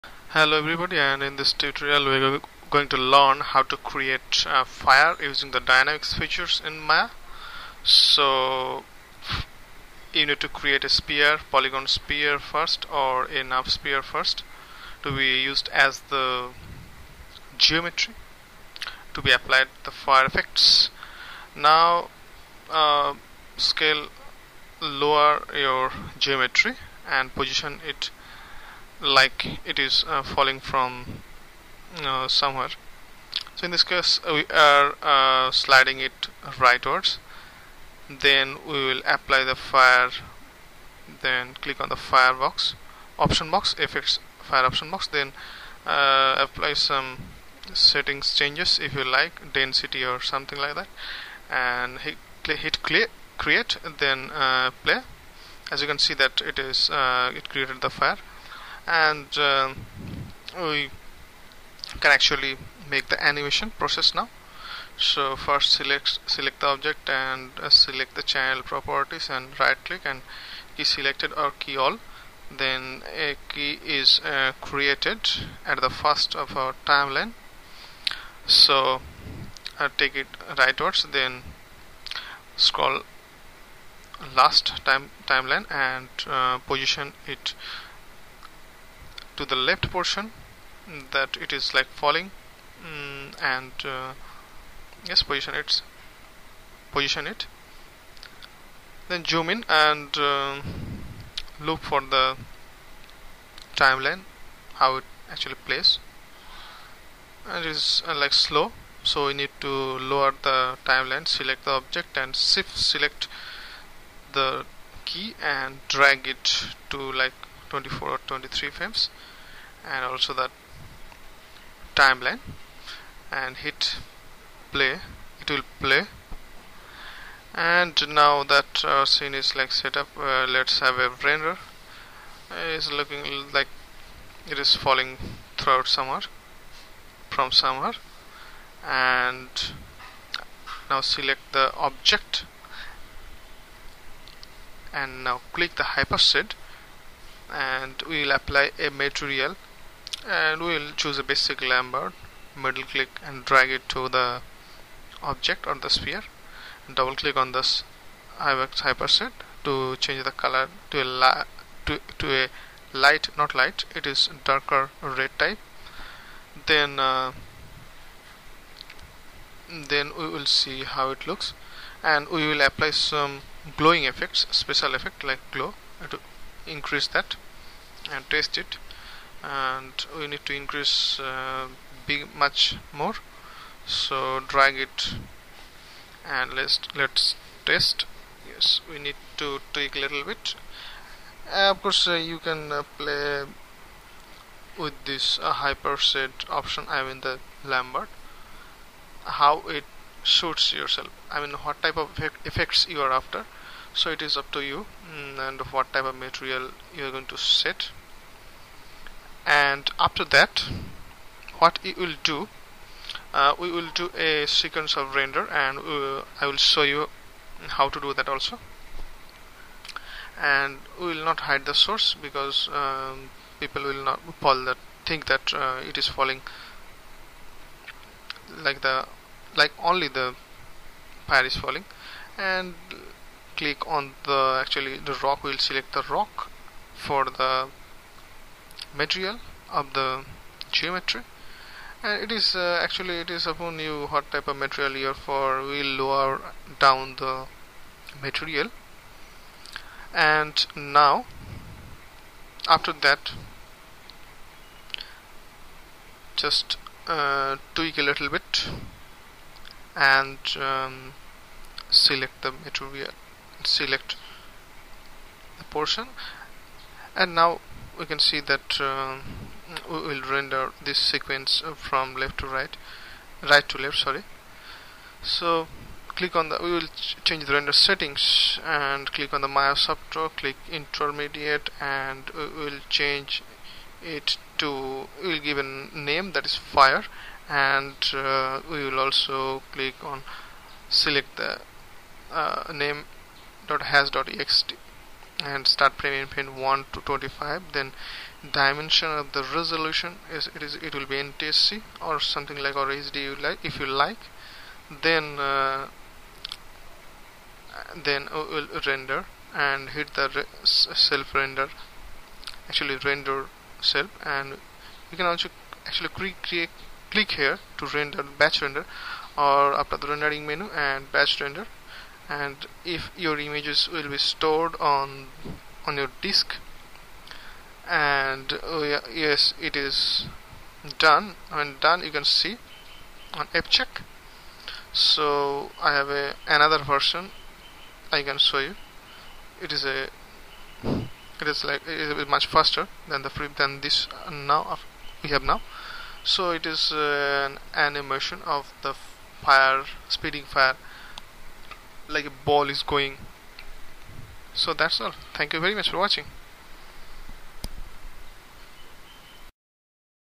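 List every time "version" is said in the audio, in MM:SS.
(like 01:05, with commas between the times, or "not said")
05:36.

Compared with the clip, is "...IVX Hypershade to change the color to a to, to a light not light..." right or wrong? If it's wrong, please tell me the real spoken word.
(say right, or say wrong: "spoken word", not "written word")
right.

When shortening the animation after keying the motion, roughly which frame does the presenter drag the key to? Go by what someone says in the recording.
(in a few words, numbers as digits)
24.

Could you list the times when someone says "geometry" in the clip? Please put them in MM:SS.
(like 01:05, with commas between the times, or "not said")
00:17, 00:26, 04:00.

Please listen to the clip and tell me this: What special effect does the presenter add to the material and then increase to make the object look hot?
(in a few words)
Glow.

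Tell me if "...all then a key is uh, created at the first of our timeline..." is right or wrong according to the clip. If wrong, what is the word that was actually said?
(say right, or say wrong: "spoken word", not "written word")
right.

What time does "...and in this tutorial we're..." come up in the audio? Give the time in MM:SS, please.
00:00.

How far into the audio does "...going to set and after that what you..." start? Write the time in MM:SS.
03:27.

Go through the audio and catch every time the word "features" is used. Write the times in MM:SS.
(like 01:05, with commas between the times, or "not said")
00:06.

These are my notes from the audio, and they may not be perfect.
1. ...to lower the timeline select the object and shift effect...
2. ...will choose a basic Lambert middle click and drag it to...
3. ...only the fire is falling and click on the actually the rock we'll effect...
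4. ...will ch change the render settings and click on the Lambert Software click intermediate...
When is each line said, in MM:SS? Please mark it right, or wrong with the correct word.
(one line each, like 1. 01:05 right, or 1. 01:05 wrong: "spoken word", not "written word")
1. 01:49 wrong: "select", not "effect"
2. 02:30 right
3. 03:49 wrong: "select", not "effect"
4. 04:36 wrong: "Maya", not "Lambert".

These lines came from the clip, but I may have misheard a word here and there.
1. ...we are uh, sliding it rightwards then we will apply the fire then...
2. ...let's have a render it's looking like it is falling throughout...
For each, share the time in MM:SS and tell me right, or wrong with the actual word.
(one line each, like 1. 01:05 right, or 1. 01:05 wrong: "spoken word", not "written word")
1. 00:34 right
2. 02:10 right.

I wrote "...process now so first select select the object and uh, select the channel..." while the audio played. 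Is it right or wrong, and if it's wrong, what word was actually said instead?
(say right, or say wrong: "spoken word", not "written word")
right.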